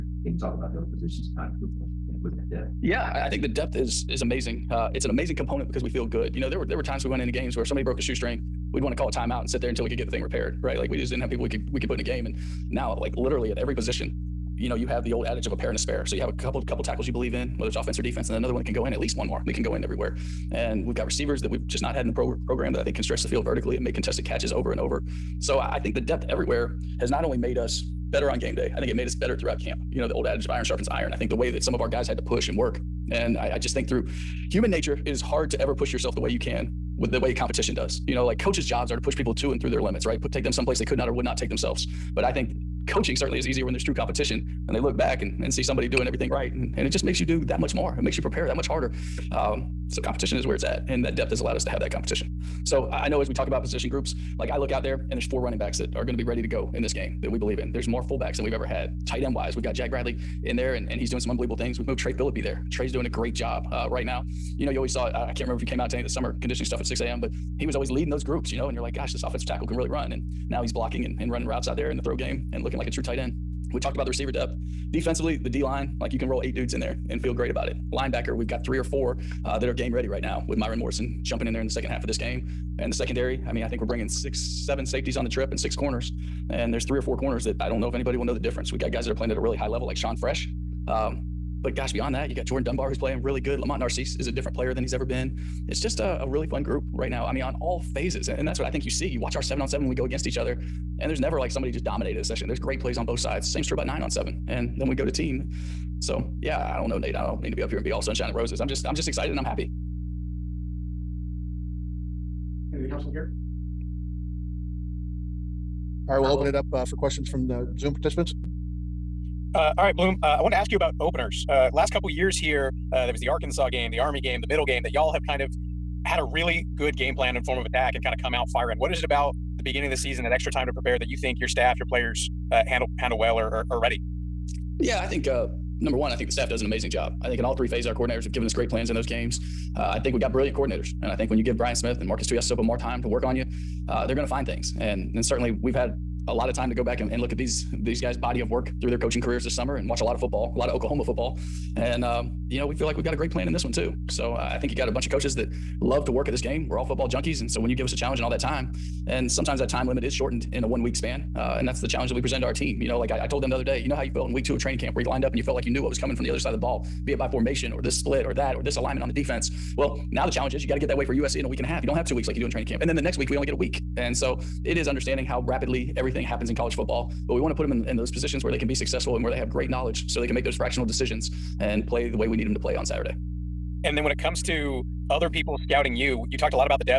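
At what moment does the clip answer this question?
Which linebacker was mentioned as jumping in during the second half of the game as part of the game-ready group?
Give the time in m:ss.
1:20.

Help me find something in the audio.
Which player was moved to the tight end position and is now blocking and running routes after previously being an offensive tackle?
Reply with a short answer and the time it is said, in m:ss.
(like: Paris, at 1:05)
Trey Phillippe, at 1:01.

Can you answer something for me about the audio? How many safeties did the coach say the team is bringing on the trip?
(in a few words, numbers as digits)
6 or 7.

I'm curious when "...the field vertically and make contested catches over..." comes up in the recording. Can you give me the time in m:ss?
0:23.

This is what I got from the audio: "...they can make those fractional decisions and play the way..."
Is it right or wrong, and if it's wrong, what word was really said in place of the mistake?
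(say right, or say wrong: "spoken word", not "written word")
right.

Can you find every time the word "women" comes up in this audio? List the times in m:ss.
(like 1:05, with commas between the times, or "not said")
not said.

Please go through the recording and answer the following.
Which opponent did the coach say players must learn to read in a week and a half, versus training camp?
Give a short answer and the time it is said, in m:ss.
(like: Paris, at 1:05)
USC, at 2:51.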